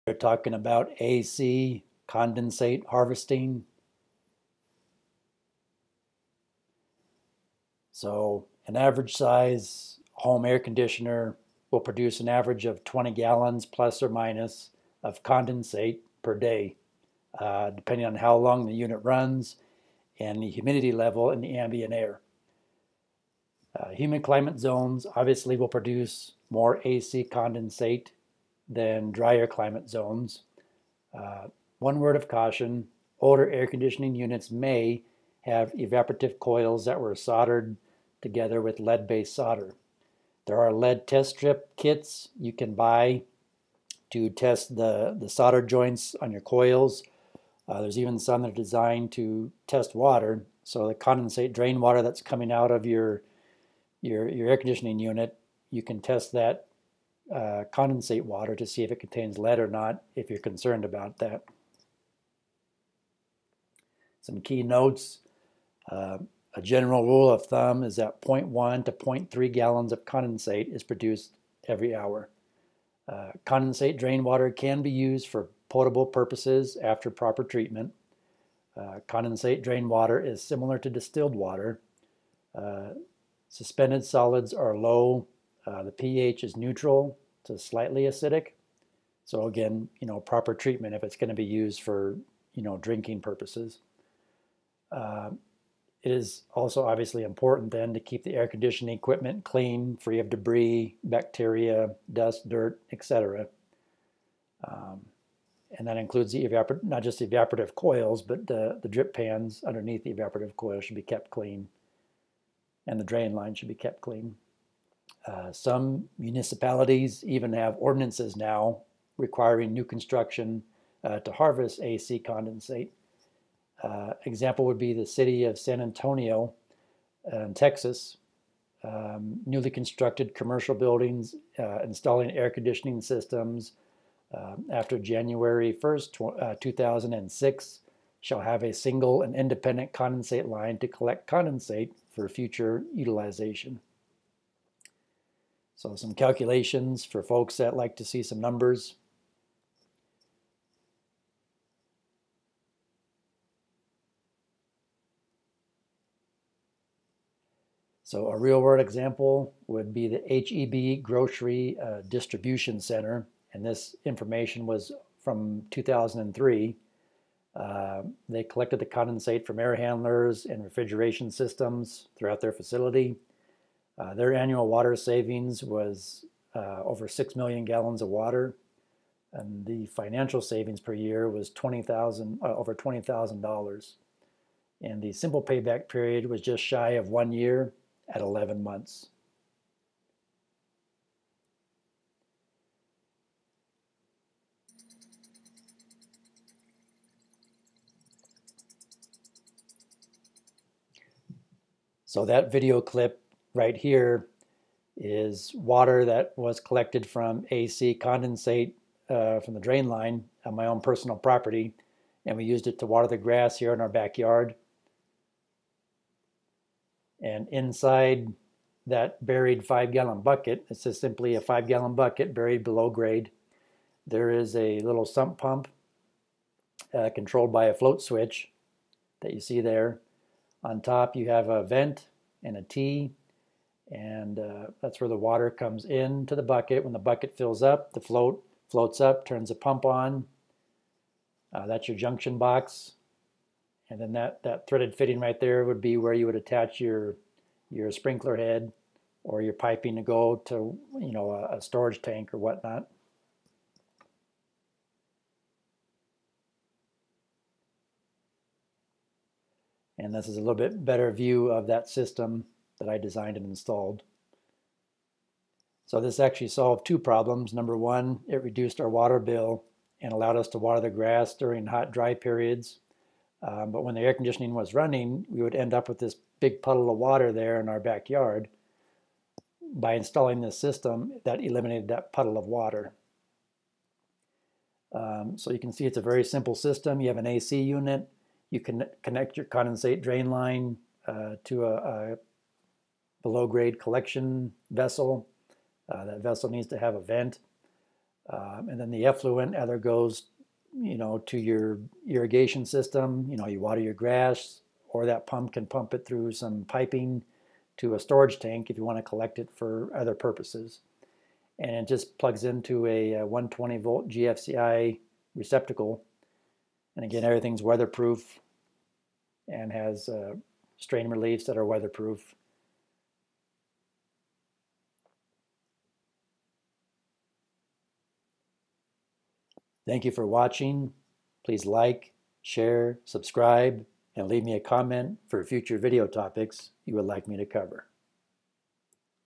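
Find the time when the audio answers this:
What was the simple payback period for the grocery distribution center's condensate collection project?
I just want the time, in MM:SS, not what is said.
03:08.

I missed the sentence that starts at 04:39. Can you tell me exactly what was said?
By installing this system, that eliminated that puddle of water.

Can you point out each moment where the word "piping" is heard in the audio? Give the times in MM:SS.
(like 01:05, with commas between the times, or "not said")
04:09, 05:06.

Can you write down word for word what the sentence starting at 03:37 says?
And inside that buried five gallon bucket, it's just simply a five gallon bucket buried below grade.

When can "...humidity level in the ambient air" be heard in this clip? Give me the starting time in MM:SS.
00:20.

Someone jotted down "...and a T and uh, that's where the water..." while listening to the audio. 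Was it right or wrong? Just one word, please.
right.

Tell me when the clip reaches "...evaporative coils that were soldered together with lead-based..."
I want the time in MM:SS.
00:35.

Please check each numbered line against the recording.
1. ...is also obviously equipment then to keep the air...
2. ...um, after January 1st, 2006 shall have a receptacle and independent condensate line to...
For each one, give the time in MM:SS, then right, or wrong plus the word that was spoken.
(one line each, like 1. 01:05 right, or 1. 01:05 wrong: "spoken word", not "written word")
1. 01:36 wrong: "important", not "equipment"
2. 02:14 wrong: "single", not "receptacle".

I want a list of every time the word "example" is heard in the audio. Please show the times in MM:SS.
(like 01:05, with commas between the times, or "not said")
02:04, 02:38.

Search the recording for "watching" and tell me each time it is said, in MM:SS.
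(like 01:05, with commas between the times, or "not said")
05:30.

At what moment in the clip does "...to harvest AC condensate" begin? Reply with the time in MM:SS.
02:01.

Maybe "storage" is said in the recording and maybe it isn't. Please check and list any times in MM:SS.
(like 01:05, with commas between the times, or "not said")
04:11, 05:07.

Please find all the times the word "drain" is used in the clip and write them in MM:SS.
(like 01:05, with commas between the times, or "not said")
00:51, 01:13, 01:19, 01:53, 03:29, 04:50.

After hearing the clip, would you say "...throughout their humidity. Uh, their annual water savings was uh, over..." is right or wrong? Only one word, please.
wrong.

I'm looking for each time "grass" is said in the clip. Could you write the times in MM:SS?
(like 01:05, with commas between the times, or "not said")
03:33, 04:30, 05:03.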